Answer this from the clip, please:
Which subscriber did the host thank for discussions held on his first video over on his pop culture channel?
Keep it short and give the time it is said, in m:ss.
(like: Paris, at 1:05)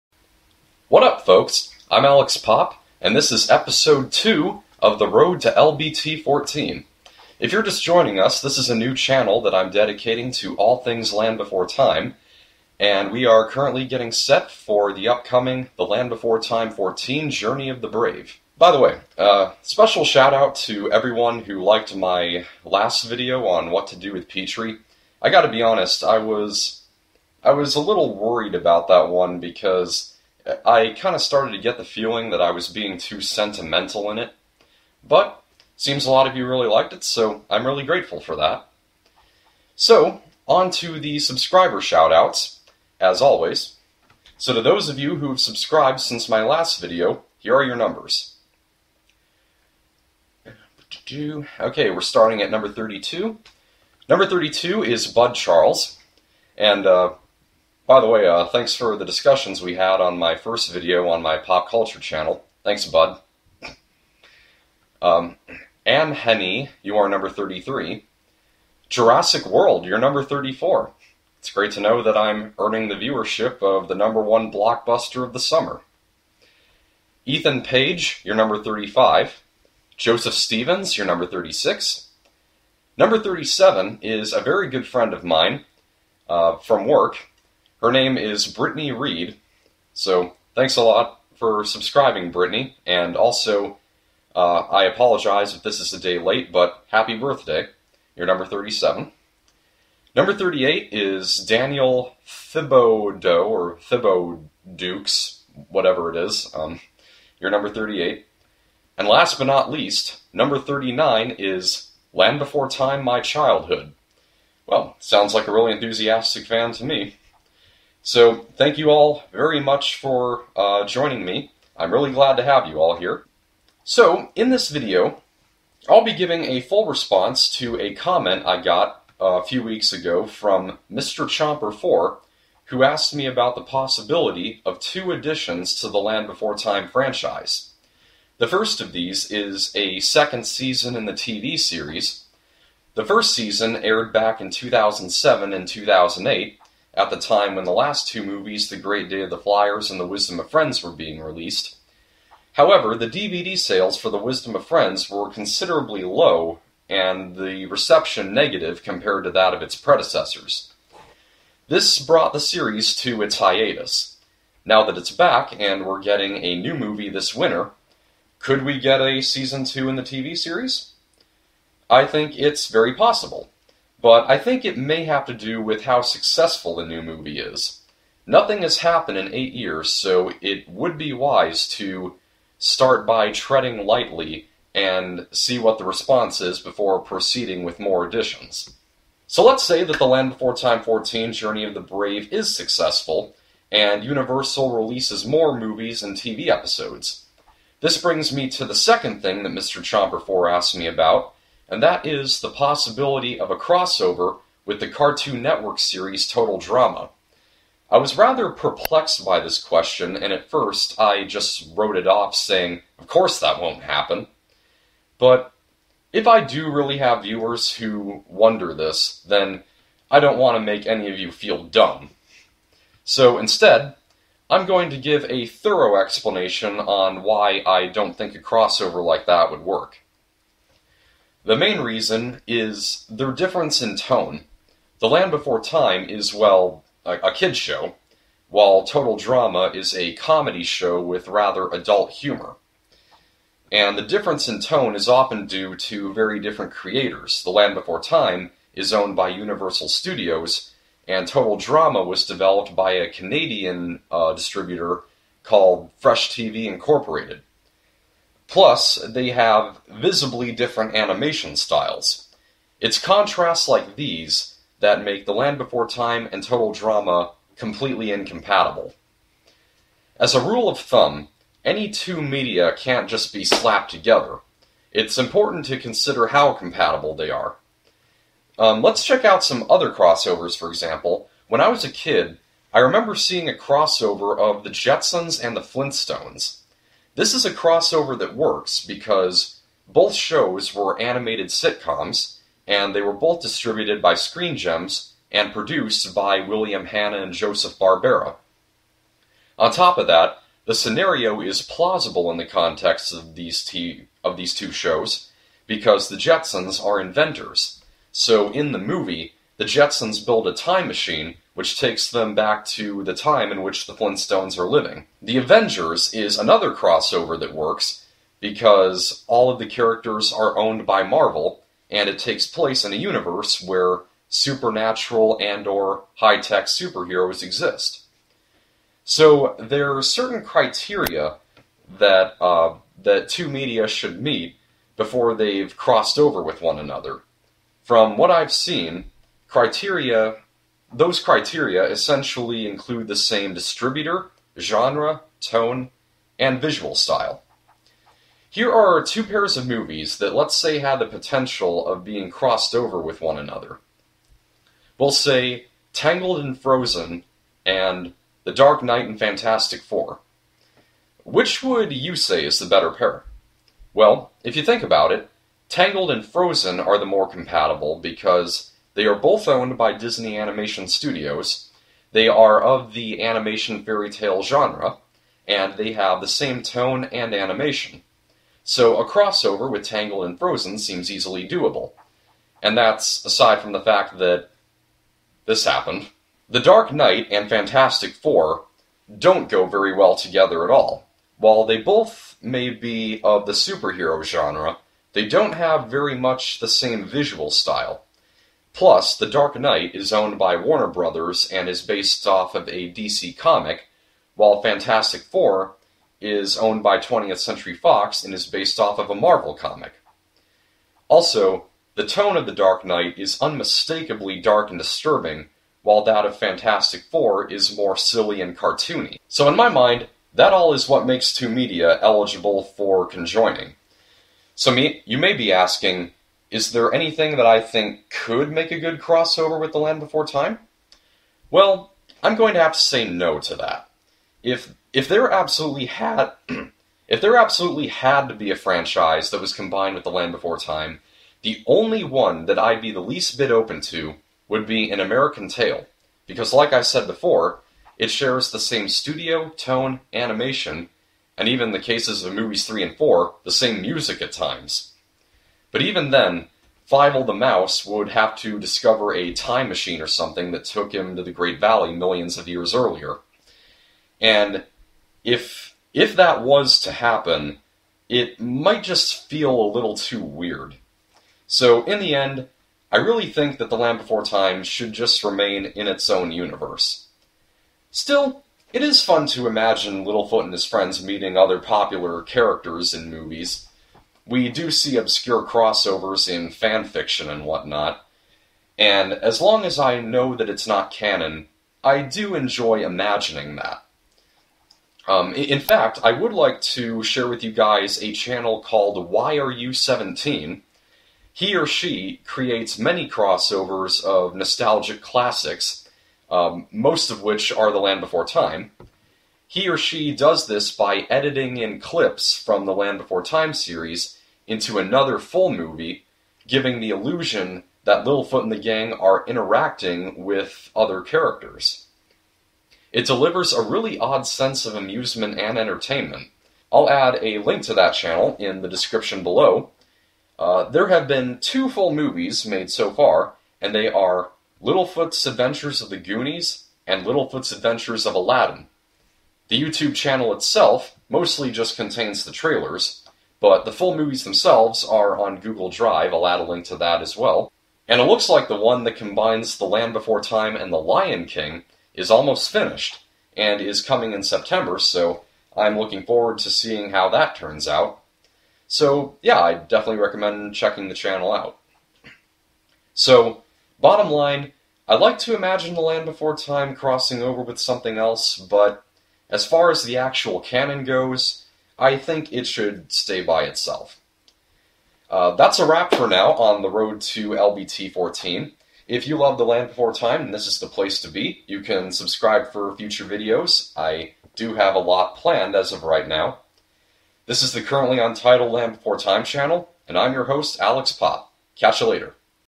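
Bud Charles, at 0:55.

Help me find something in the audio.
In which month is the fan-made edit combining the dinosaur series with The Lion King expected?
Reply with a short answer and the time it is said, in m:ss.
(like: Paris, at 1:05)
September, at 9:14.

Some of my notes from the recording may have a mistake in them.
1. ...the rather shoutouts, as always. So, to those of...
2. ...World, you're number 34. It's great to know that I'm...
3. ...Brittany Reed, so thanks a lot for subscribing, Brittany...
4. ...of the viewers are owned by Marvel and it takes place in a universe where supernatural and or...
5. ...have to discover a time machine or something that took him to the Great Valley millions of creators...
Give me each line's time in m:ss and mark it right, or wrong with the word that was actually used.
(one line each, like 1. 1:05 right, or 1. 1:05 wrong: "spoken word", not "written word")
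1. 0:40 wrong: "subscriber", not "rather"
2. 1:09 right
3. 1:28 right
4. 5:19 wrong: "characters", not "viewers"
5. 7:38 wrong: "years", not "creators".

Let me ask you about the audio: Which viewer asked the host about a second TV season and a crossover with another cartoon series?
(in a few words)
Mr. Chomper4.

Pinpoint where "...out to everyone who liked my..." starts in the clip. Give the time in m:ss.
0:20.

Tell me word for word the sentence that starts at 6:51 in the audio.
Also, the tone of The Dark Knight is unmistakably dark and disturbing, while that of Fantastic Four is more silly and cartoony.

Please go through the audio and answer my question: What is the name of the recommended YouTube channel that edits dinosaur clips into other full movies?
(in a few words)
Why Are You 17?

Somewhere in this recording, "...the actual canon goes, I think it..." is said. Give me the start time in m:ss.
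9:29.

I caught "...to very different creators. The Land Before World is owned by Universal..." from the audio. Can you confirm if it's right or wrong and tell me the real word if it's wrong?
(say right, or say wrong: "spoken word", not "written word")
wrong: "Time", not "World".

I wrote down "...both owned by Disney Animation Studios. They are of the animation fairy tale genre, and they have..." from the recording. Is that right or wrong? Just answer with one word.
right.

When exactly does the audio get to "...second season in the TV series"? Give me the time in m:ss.
2:19.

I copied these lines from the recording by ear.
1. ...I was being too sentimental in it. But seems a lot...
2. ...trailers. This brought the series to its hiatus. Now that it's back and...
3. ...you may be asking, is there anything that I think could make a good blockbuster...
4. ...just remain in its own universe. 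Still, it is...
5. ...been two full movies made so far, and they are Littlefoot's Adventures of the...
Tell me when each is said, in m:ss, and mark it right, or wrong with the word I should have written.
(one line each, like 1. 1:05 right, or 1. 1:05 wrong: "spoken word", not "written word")
1. 0:32 right
2. 2:39 wrong: "predecessors", not "trailers"
3. 7:05 wrong: "crossover", not "blockbuster"
4. 7:54 right
5. 8:51 right.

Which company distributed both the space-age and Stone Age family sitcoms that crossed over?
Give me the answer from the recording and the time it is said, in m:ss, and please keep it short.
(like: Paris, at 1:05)
Screen Gems, at 4:54.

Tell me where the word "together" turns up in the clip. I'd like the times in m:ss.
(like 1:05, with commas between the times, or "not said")
4:33, 6:30.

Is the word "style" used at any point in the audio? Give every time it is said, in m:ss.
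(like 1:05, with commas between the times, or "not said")
4:21, 5:46, 6:37.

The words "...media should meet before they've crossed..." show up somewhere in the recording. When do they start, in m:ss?
5:33.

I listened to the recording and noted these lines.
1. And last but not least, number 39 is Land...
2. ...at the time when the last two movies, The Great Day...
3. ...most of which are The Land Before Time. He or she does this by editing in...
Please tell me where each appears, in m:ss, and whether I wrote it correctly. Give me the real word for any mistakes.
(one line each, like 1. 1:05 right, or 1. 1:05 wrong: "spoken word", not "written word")
1. 1:48 right
2. 2:26 right
3. 8:26 right.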